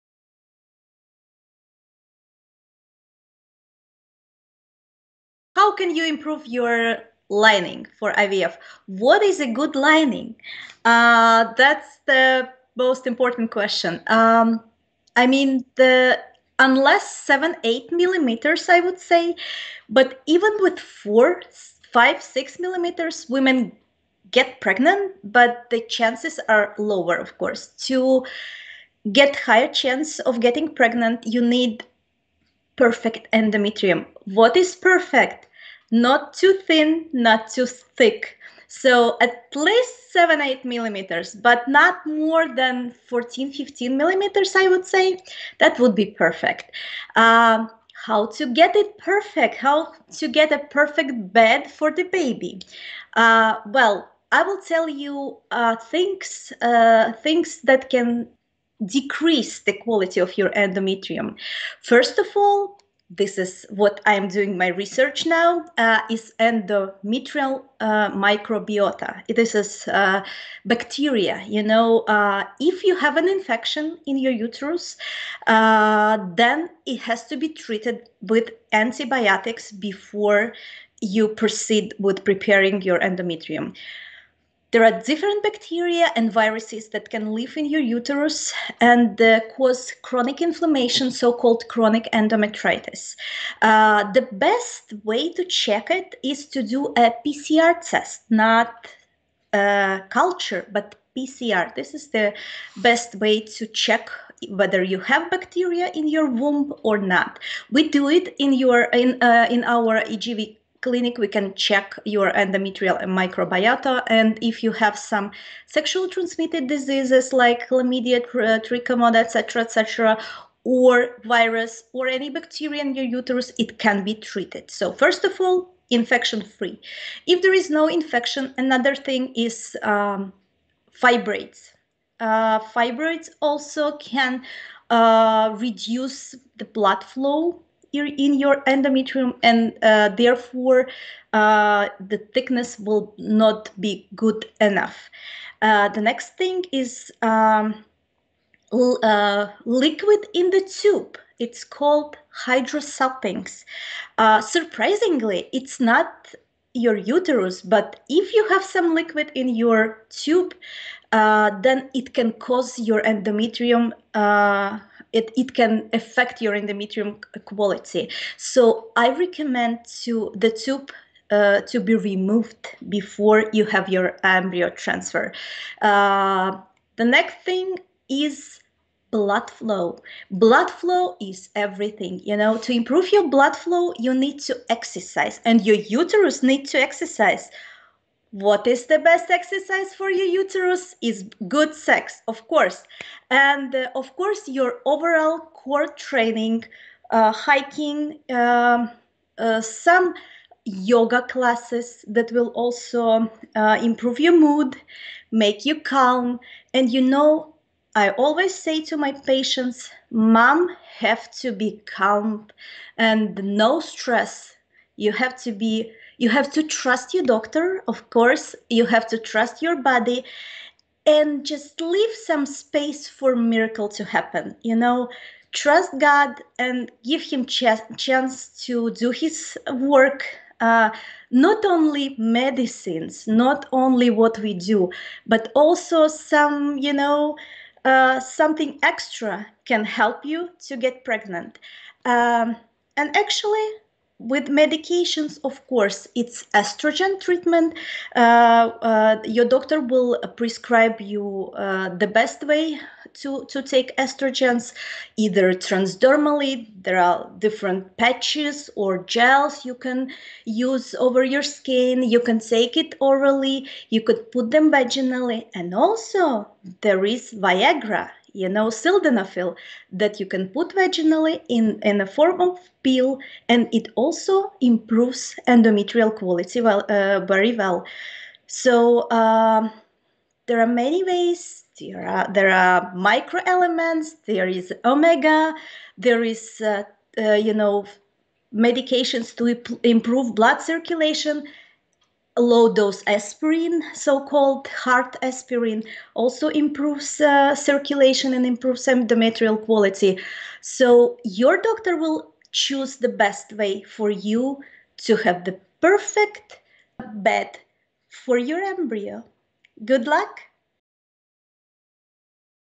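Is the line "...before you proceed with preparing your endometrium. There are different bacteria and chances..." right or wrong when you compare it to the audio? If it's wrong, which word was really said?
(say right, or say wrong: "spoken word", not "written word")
wrong: "viruses", not "chances".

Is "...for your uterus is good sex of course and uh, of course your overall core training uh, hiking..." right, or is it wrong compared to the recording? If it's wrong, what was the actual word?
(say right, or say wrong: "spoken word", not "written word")
right.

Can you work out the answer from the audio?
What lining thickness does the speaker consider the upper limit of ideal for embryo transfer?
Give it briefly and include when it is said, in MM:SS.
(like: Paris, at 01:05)
14 to 15 millimeters, at 00:43.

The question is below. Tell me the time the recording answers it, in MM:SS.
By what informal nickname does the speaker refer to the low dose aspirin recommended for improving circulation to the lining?
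04:54.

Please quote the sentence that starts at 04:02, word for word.
Um, and actually, with medications, of course, it's estrogen treatment.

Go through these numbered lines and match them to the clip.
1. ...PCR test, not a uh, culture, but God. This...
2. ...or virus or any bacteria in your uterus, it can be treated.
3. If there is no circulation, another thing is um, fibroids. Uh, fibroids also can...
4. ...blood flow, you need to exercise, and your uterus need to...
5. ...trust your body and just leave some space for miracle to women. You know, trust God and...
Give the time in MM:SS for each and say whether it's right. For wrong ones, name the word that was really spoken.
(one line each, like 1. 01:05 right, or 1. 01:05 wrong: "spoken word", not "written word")
1. 01:37 wrong: "PCR", not "God"
2. 02:00 right
3. 02:07 wrong: "infection", not "circulation"
4. 03:03 right
5. 03:39 wrong: "happen", not "women".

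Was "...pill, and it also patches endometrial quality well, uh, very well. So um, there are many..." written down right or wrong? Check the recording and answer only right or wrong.
wrong.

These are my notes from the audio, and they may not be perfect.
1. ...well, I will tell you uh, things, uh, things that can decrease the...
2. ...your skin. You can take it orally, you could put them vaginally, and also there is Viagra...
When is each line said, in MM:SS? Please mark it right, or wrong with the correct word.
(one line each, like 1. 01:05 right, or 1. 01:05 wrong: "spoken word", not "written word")
1. 00:53 right
2. 04:21 right.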